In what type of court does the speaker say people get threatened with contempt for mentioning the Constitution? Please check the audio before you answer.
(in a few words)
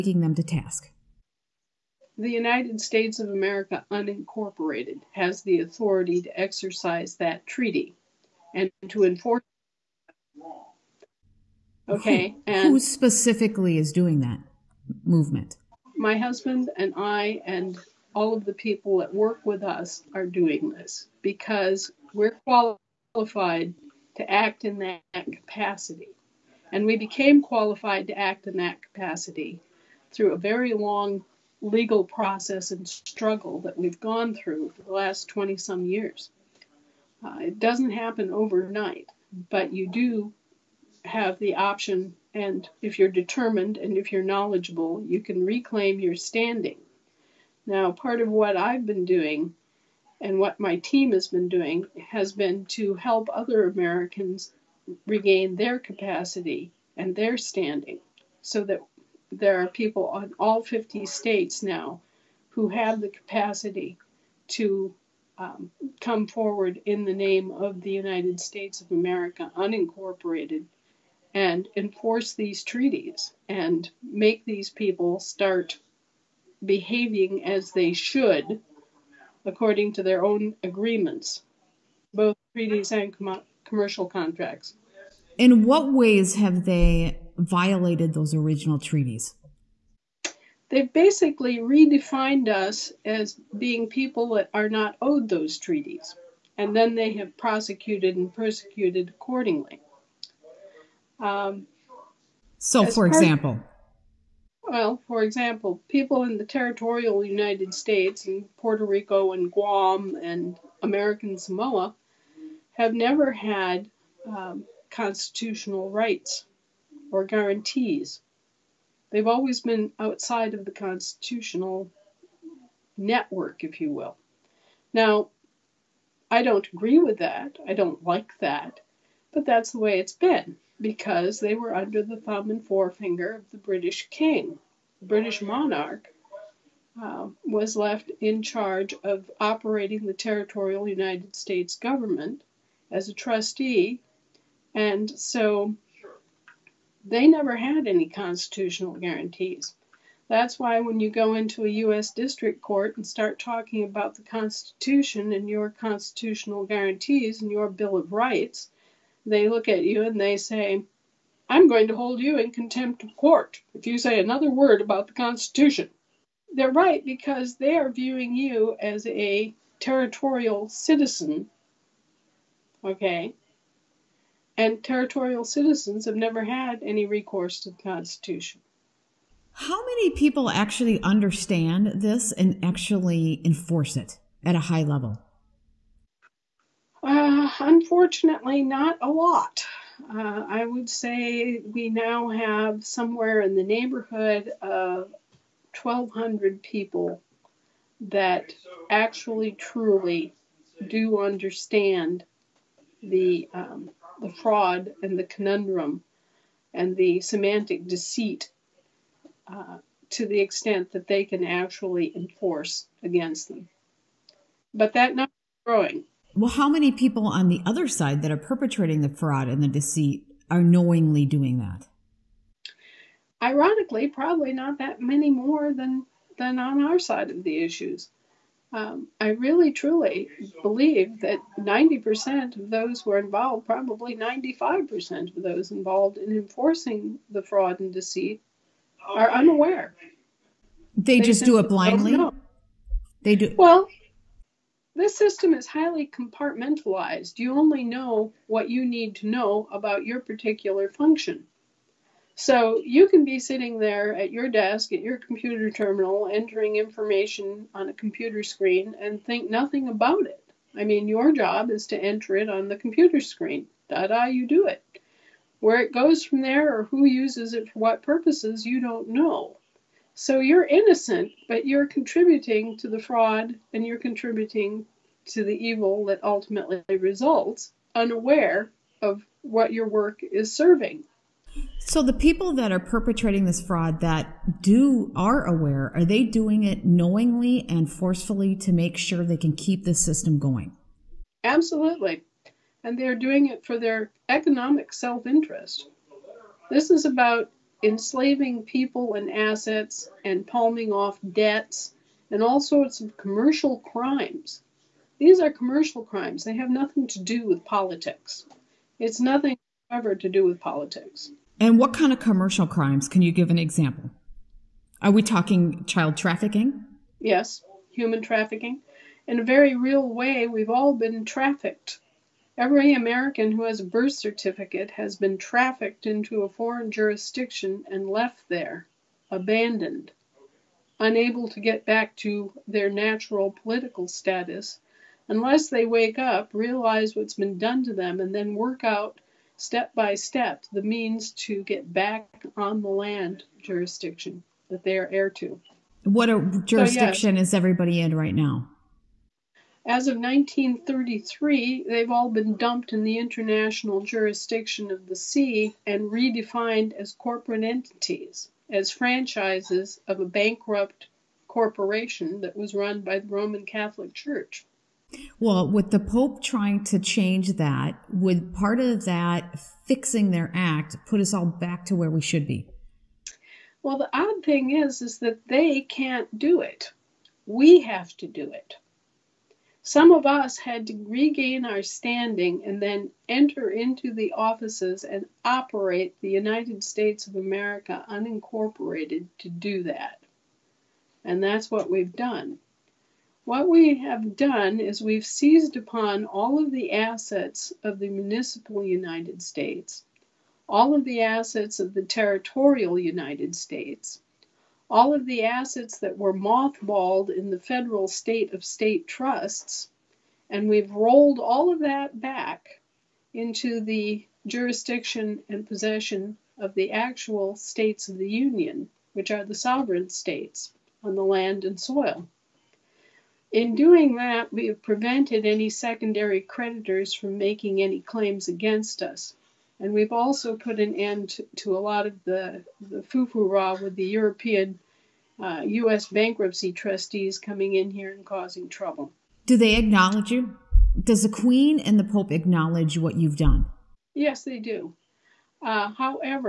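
U.S. district court.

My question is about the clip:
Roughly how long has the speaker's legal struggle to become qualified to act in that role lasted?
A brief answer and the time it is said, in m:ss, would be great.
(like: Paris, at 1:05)
20 some years, at 0:35.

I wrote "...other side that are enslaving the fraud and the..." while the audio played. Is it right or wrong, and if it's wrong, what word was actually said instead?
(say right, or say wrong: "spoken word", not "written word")
wrong: "perpetrating", not "enslaving".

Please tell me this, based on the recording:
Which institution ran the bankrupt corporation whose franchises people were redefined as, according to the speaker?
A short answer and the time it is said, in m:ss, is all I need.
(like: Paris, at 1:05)
Roman Catholic Church, at 6:03.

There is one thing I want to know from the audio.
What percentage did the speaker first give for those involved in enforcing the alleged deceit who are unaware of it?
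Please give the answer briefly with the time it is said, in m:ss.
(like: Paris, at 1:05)
90%, at 3:51.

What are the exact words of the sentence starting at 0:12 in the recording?
Who, and who specifically is doing that movement?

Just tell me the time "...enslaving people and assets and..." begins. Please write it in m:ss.
4:57.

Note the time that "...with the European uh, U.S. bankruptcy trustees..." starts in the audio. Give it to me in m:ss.
7:13.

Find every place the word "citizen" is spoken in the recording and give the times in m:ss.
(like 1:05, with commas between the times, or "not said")
2:50, 2:55.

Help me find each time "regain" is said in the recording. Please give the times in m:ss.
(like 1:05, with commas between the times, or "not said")
0:55, 6:21.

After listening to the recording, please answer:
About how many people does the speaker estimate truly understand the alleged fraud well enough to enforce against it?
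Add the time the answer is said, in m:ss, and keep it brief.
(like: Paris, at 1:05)
1,200, at 3:15.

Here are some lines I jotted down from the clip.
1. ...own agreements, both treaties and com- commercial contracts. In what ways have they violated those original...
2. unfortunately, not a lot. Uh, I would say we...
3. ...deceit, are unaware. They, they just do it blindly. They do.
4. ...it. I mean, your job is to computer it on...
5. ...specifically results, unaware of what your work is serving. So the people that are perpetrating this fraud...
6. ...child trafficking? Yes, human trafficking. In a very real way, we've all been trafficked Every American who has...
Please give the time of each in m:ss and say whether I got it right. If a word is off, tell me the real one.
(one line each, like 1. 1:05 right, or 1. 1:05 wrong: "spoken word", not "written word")
1. 1:20 right
2. 3:07 right
3. 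3:57 right
4. 4:20 wrong: "enter", not "computer"
5. 4:36 wrong: "ultimately", not "specifically"
6. 5:15 right.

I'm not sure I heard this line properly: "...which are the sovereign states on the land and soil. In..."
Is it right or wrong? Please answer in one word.
right.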